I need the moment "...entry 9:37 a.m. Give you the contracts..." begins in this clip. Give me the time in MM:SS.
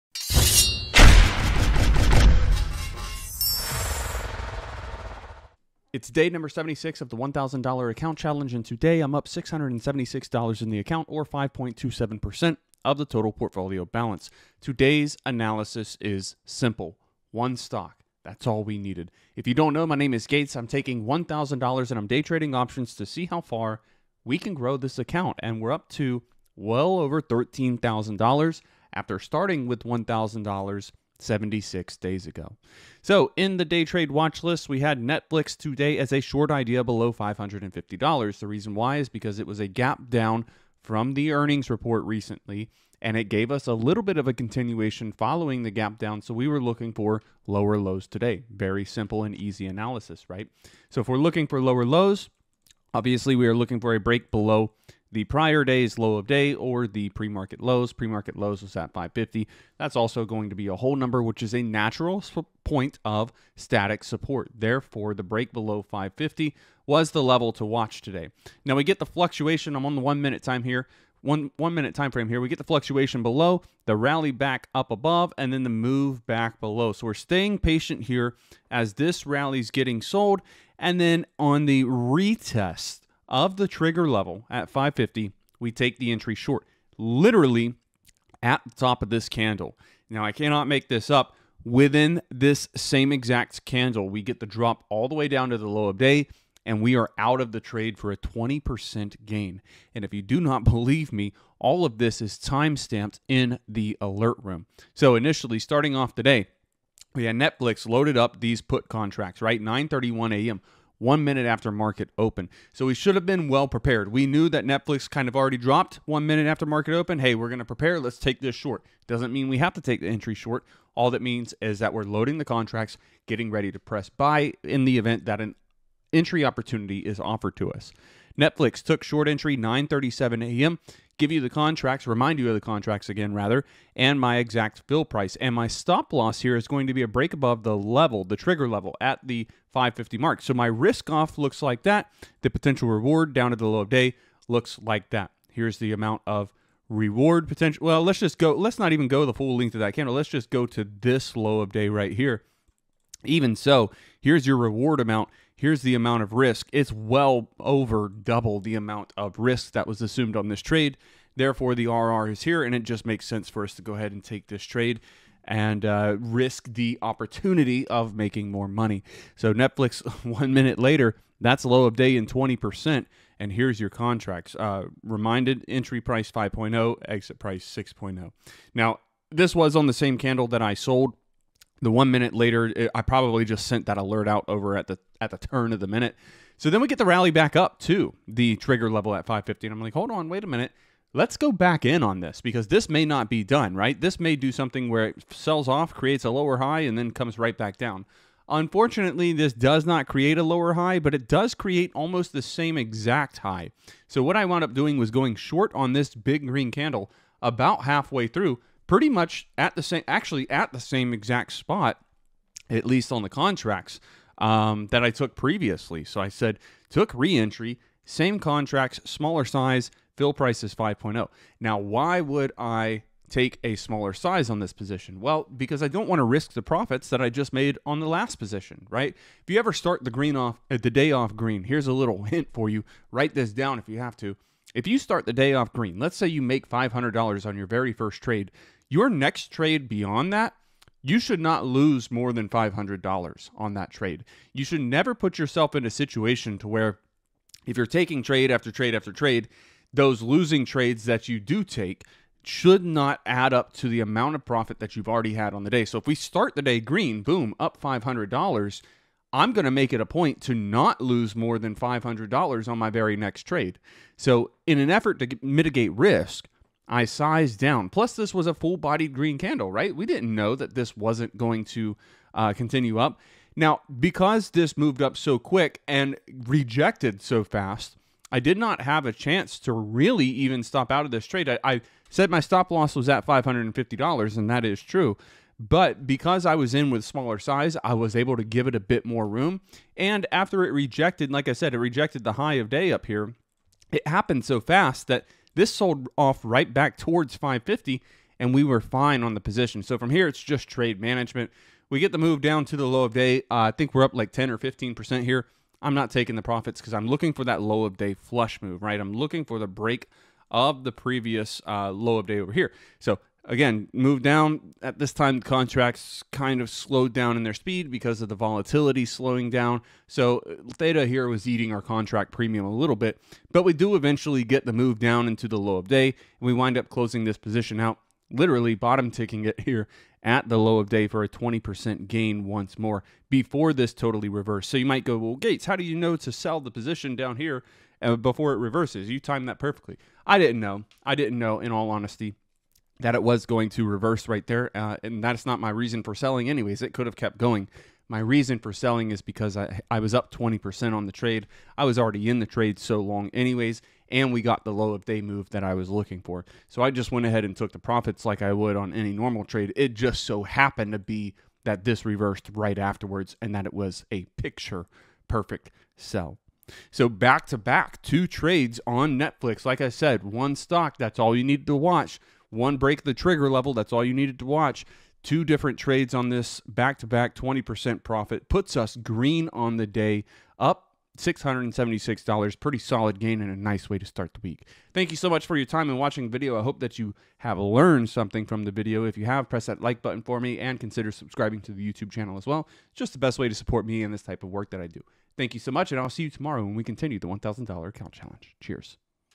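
02:09.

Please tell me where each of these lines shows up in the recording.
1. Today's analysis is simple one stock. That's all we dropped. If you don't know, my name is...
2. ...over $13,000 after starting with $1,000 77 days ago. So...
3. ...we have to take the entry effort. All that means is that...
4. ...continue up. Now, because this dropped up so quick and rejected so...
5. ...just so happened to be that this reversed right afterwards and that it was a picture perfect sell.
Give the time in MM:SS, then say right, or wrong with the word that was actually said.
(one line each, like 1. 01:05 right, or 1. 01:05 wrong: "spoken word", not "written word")
1. 00:14 wrong: "needed", not "dropped"
2. 00:26 wrong: "76", not "77"
3. 01:59 wrong: "short", not "effort"
4. 04:32 wrong: "moved", not "dropped"
5. 05:59 right.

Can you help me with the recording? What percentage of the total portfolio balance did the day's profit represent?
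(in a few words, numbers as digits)
5.27%.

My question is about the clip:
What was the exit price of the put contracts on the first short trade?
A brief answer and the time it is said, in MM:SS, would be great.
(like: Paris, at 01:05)
6.0, at 02:57.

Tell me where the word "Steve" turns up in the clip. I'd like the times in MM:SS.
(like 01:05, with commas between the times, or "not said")
not said.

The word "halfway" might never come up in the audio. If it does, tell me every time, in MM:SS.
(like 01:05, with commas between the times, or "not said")
03:27.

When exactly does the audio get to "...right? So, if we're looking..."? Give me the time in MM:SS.
00:50.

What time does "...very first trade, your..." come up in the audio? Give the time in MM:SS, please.
03:57.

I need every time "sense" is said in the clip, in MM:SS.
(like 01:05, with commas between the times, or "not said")
02:43.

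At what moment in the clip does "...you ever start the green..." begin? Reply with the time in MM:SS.
03:49.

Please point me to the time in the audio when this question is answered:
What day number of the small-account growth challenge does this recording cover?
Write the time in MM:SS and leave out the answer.
00:06.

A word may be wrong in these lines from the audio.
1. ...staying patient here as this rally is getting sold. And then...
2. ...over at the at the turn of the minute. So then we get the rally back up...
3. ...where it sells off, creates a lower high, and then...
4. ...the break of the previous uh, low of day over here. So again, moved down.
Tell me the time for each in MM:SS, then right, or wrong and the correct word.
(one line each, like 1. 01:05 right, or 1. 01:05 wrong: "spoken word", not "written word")
1. 01:17 right
2. 03:04 right
3. 03:14 right
4. 05:09 right.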